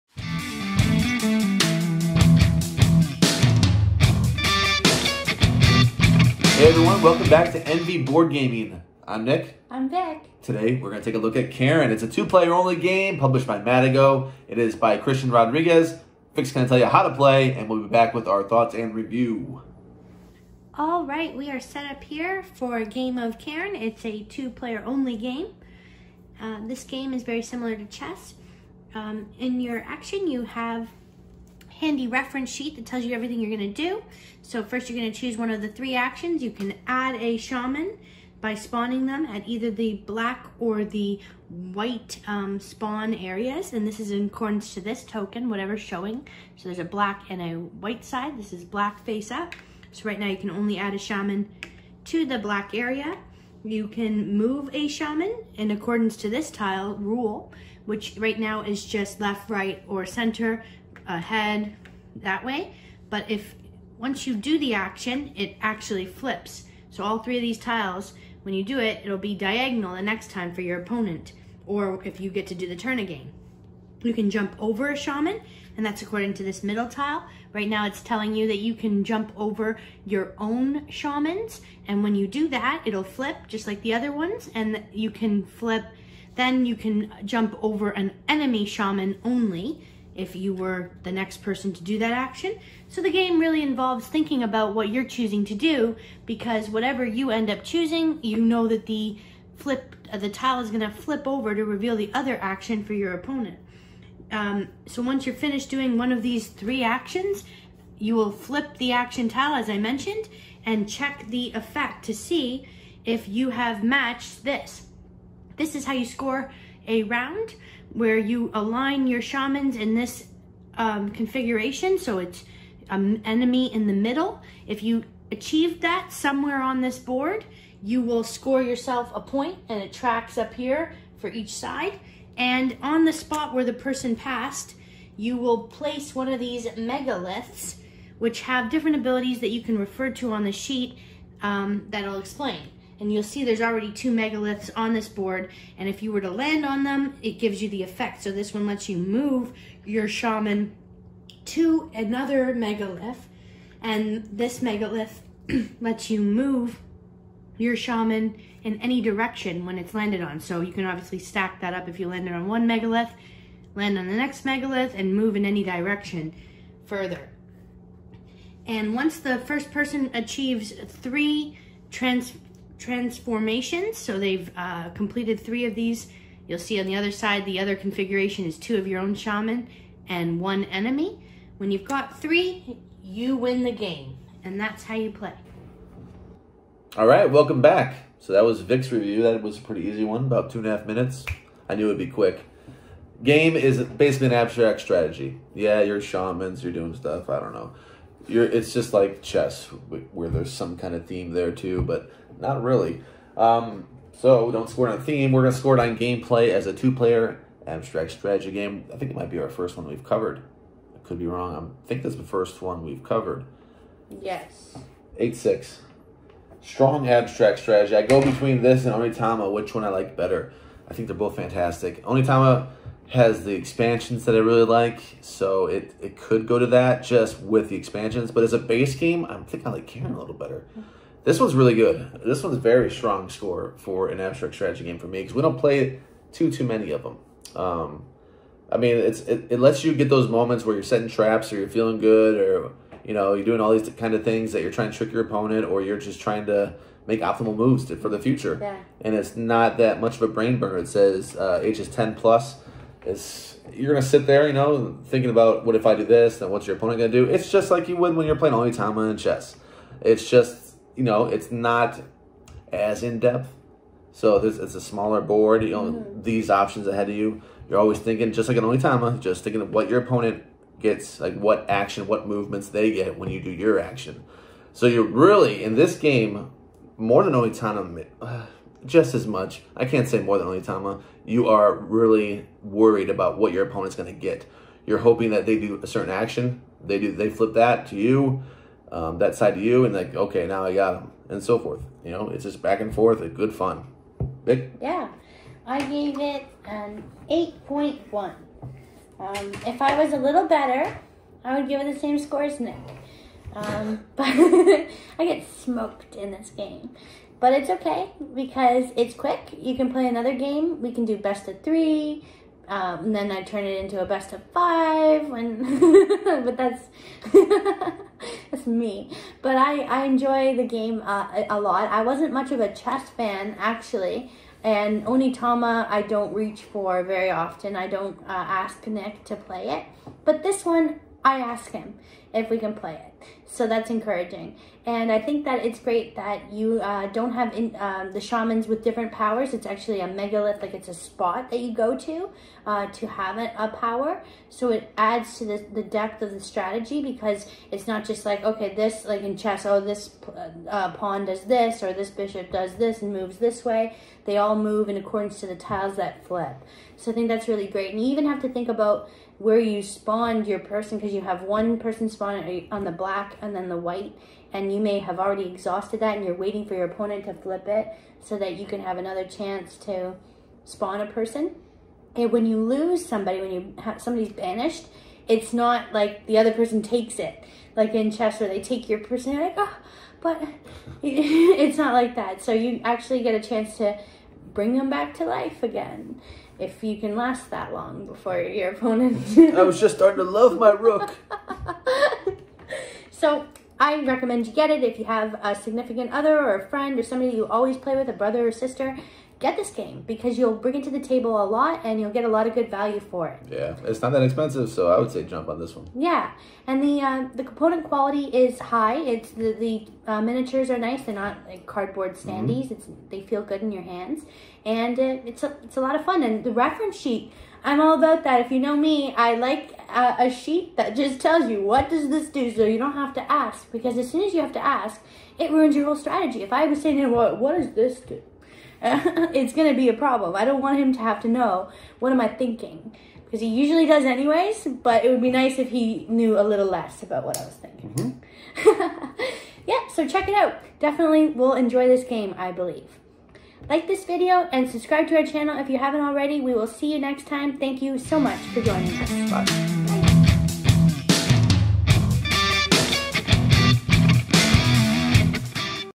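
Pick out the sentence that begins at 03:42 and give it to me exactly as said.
Onitama has the expansions that I really like, so it, it could go to that just with the expansions.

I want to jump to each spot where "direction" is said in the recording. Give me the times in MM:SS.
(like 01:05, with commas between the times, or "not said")
02:39, 02:45.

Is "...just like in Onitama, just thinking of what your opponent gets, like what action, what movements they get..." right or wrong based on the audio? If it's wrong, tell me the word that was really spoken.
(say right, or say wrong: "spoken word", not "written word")
right.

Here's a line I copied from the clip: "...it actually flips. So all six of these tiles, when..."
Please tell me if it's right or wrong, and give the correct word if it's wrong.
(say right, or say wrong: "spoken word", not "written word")
wrong: "three", not "six".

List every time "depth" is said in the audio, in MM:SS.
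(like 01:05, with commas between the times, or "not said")
04:23, 05:45.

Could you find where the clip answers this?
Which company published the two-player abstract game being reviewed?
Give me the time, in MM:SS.
00:13.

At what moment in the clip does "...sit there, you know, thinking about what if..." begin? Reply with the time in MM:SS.
04:14.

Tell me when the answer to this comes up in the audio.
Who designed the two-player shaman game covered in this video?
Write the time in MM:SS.
00:14.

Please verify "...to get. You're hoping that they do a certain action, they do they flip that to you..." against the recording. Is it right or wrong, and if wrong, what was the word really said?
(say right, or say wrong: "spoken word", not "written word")
right.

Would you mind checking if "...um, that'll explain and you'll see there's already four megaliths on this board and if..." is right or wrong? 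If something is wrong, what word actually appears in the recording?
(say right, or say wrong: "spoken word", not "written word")
wrong: "two", not "four".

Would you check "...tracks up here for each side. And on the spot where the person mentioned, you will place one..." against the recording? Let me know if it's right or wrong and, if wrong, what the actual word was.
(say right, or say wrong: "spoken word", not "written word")
wrong: "passed", not "mentioned".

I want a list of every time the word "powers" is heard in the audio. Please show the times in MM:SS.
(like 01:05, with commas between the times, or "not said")
05:39, 05:43.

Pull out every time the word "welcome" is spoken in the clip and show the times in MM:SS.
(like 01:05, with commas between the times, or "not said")
00:07, 03:07.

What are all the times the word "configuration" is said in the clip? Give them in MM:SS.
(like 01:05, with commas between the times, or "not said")
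02:01, 02:57.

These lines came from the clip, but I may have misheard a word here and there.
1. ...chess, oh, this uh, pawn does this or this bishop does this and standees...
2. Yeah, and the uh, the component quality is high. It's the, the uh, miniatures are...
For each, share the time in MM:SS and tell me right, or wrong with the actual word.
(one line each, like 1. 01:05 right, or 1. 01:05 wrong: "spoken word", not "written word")
1. 05:49 wrong: "moves", not "standees"
2. 06:45 right.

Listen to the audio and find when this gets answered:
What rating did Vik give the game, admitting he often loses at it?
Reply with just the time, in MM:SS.
04:57.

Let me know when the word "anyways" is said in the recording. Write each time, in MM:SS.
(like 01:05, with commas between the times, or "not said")
07:14.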